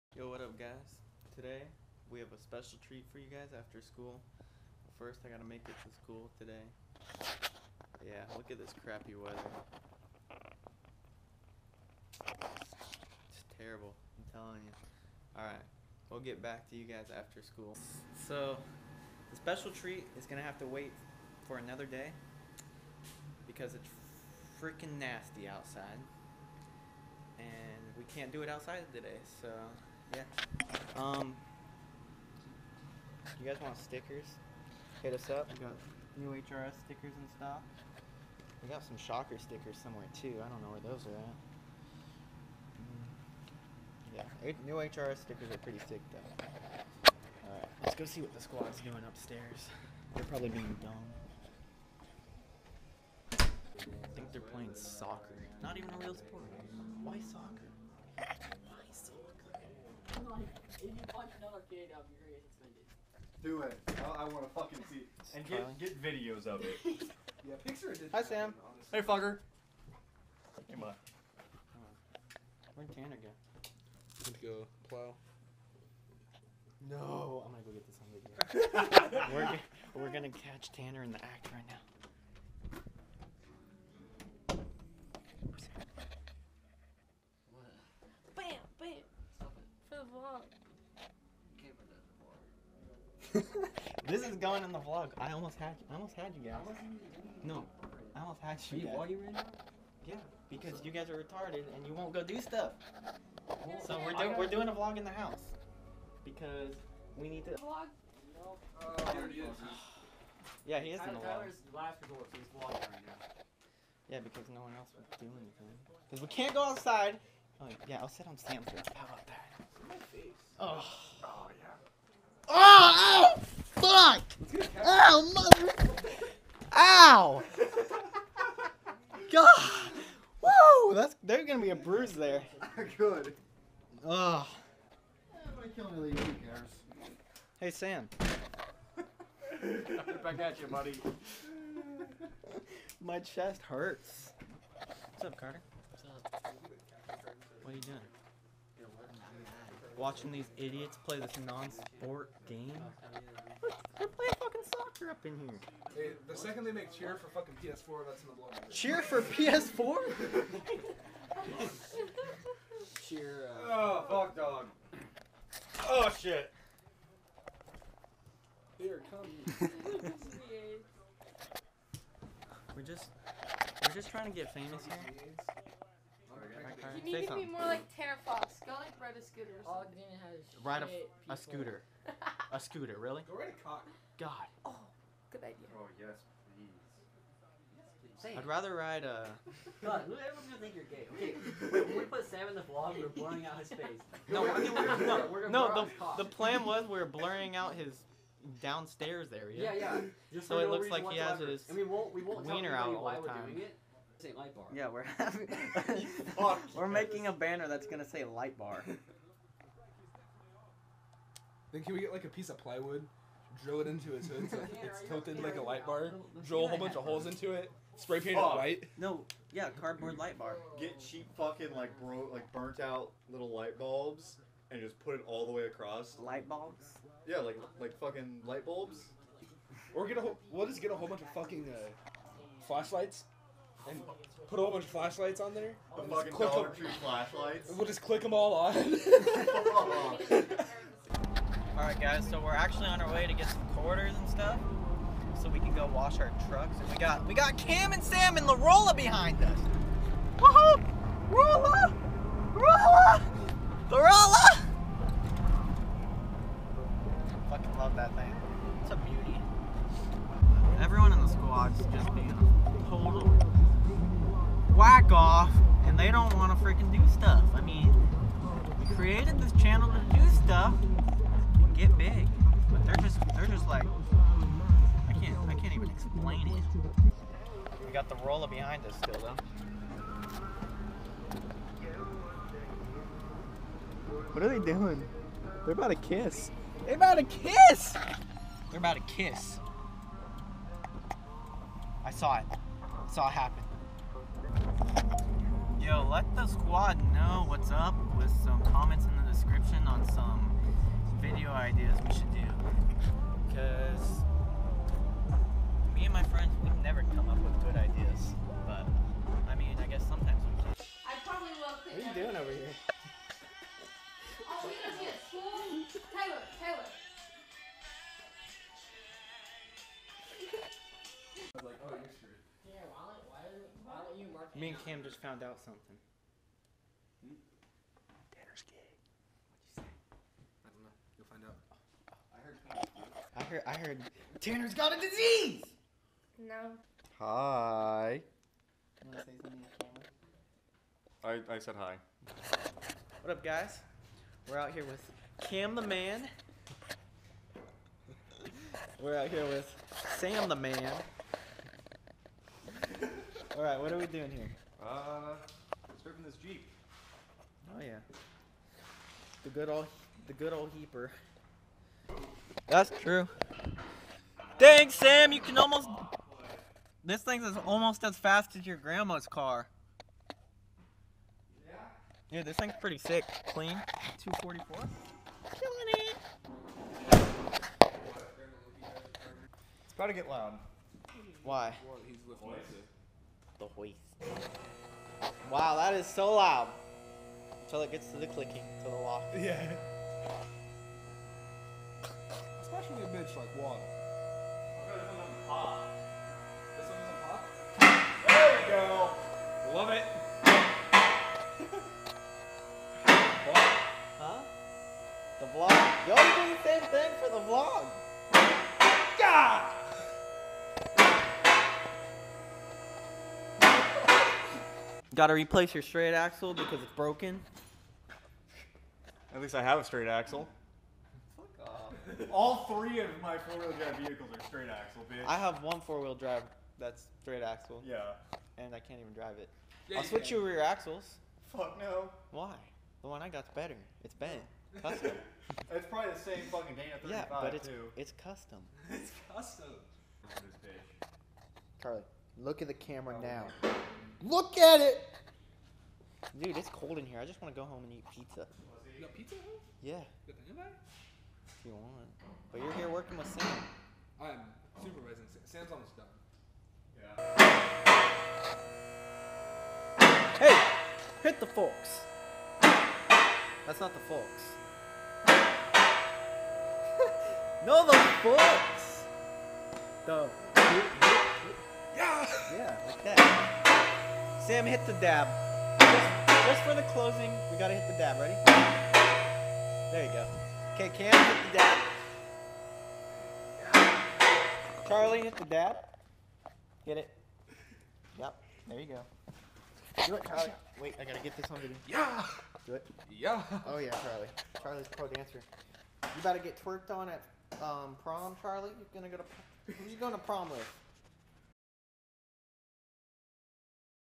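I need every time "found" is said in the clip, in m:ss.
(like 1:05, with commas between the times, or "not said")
5:25.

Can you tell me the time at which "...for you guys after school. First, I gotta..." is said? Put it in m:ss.
0:03.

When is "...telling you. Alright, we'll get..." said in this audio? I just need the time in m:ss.
0:14.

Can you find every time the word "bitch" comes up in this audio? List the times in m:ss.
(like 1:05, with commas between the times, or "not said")
7:05.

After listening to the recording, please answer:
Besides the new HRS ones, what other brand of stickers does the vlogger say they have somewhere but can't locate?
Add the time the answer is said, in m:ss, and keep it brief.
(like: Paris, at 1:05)
Shocker, at 0:38.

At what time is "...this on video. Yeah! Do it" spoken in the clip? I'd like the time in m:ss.
8:11.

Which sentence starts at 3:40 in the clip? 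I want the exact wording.
Get cheap fucking like bro like burnt out little light bulbs and just put it all the way across.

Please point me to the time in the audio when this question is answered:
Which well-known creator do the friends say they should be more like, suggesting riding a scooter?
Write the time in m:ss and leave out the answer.
2:57.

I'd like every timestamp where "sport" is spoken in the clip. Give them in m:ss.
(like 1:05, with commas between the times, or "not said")
0:56, 2:31.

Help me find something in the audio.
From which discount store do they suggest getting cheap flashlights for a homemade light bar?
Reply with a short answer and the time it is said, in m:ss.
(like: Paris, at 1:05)
Dollar Tree, at 3:56.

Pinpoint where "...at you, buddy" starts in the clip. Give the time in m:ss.
2:20.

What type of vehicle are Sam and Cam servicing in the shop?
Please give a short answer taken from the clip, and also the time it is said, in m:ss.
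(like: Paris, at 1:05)
Jeep, at 5:56.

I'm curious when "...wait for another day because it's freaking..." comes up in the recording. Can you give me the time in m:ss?
0:20.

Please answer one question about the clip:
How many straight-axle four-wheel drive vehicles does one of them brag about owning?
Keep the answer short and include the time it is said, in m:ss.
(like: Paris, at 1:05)
3, at 7:02.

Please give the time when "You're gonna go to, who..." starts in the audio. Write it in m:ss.
8:18.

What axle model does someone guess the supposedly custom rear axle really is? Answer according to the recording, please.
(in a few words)
Dana 35.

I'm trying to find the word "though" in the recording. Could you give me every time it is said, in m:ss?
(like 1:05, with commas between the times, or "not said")
0:46, 4:39.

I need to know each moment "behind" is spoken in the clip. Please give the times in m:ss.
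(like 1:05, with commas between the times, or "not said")
4:08, 4:38.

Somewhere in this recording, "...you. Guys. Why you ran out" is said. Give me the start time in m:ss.
1:38.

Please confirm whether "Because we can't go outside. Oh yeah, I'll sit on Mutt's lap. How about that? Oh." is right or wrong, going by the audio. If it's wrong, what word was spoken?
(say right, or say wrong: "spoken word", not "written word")
wrong: "Sam", not "Mutt".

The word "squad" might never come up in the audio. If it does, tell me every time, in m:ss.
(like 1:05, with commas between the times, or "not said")
0:48, 4:56.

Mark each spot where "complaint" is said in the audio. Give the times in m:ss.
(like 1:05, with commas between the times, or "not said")
not said.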